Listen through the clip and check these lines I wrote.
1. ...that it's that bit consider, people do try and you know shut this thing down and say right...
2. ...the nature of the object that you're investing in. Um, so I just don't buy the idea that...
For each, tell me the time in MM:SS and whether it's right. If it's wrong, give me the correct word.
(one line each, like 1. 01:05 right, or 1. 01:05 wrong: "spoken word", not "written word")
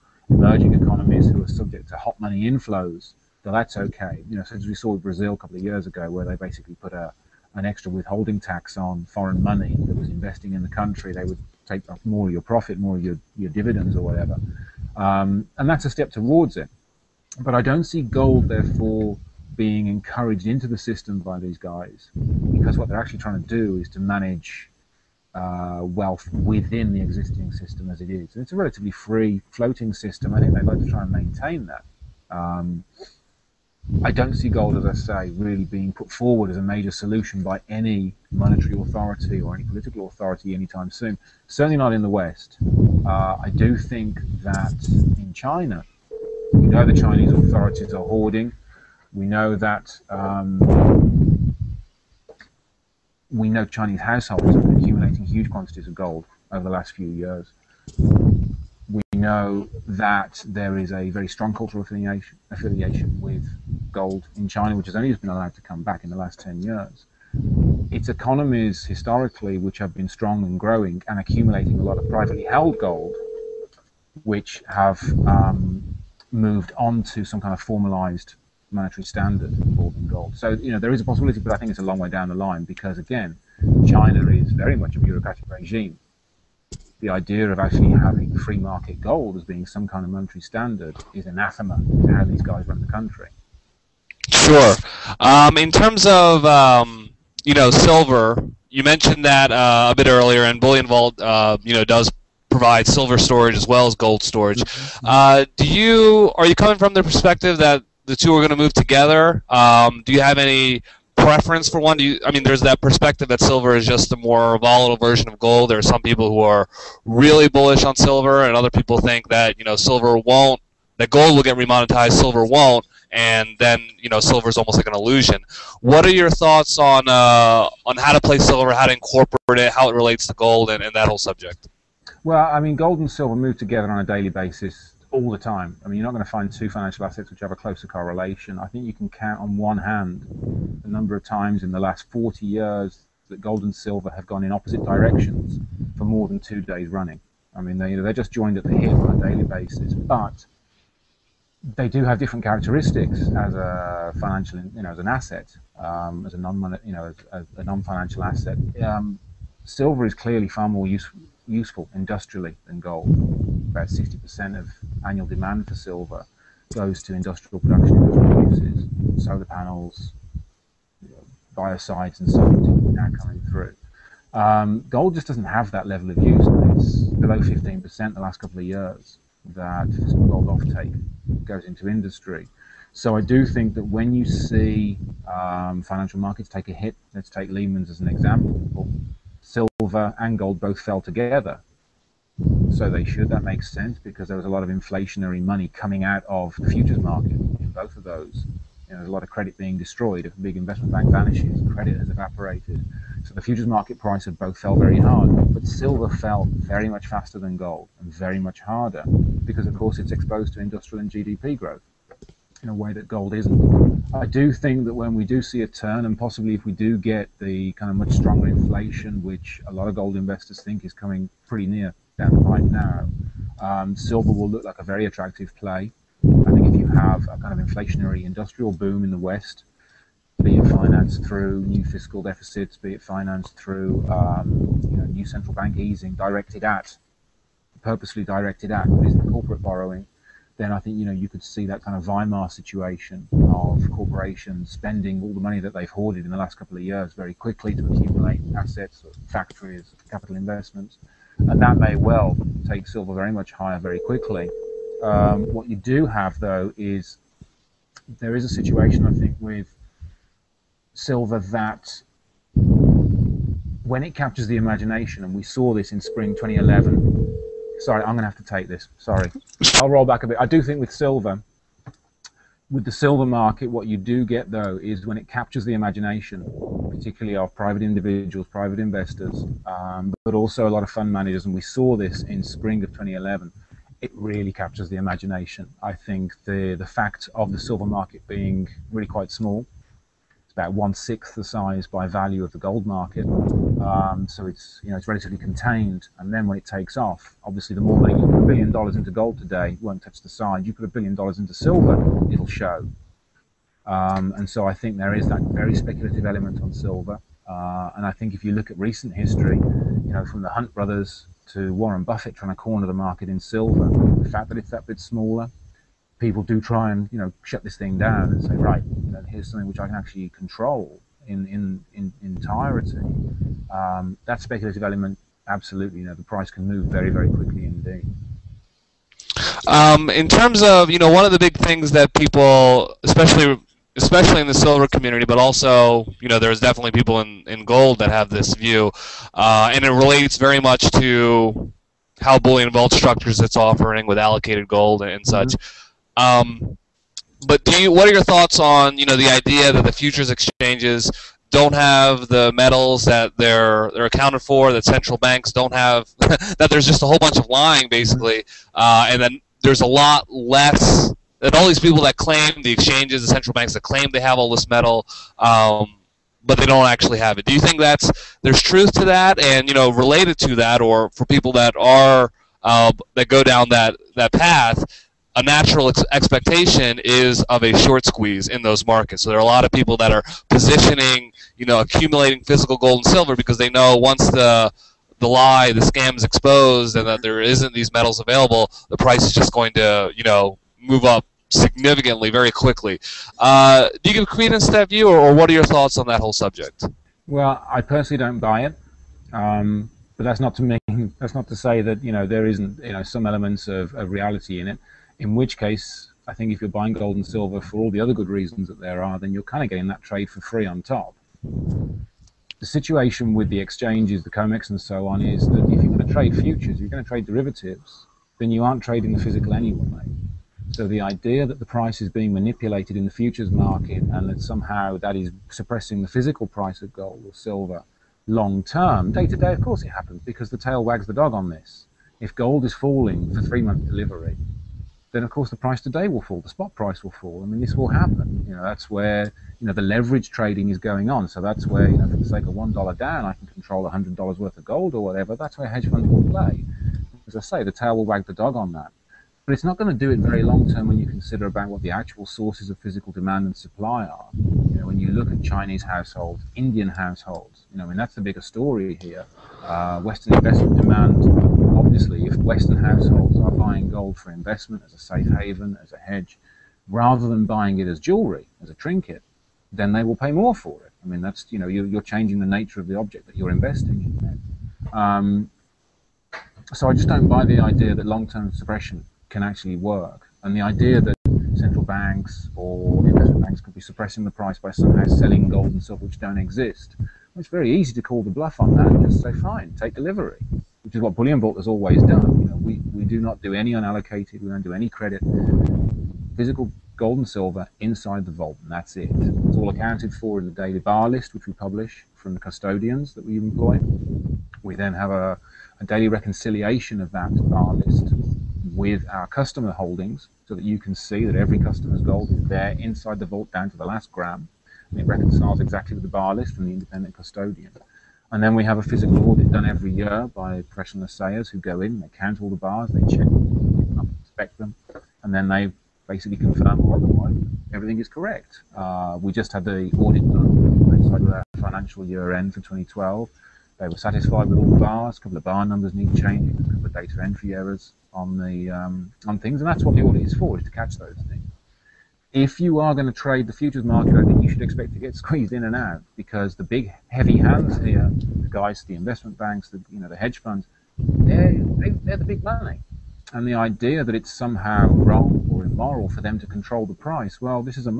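1. 05:14 wrong: "smaller", not "consider"
2. 07:52 right.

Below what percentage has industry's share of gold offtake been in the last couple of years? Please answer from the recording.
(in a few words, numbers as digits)
15%.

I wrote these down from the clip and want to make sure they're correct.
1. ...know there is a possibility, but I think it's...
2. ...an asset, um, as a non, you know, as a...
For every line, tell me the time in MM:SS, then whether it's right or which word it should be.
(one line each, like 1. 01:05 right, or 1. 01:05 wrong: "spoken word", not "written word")
1. 01:20 right
2. 02:34 right.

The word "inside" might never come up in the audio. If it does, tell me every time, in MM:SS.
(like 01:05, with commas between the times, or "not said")
08:17, 08:32.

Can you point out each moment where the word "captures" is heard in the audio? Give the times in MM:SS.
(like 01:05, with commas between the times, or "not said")
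04:24, 04:35, 04:44.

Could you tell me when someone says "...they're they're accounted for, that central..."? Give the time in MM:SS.
05:53.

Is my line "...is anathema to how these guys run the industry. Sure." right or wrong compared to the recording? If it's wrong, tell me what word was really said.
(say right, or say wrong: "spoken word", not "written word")
wrong: "country", not "industry".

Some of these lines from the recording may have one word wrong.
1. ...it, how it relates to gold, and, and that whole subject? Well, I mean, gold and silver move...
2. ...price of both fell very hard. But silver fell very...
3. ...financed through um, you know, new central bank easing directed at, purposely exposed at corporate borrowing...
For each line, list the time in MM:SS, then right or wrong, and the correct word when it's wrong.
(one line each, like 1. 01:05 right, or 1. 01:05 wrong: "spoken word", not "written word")
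1. 02:09 right
2. 03:23 right
3. 03:53 wrong: "directed", not "exposed".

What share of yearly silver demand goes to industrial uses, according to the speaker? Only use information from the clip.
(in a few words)
60%.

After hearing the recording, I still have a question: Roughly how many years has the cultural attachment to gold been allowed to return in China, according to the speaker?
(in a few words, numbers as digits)
10 years.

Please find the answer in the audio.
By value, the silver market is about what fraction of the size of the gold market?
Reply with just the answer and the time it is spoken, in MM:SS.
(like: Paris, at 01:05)
one sixth, at 04:50.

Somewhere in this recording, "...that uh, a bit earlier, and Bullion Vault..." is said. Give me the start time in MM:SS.
01:39.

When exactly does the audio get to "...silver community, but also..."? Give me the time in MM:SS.
05:34.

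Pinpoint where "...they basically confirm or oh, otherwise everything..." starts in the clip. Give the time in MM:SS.
08:45.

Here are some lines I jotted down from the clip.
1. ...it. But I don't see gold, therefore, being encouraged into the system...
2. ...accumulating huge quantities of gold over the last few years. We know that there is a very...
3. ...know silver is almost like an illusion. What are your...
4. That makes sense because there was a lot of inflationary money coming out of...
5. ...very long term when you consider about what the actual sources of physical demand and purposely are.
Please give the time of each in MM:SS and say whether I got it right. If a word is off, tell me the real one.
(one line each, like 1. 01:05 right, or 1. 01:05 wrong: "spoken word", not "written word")
1. 00:16 right
2. 00:54 right
3. 02:04 right
4. 03:13 right
5. 07:30 wrong: "supply", not "purposely".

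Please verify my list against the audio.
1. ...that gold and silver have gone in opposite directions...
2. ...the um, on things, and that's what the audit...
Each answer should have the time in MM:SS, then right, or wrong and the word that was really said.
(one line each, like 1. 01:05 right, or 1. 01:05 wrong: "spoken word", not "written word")
1. 02:23 right
2. 08:58 right.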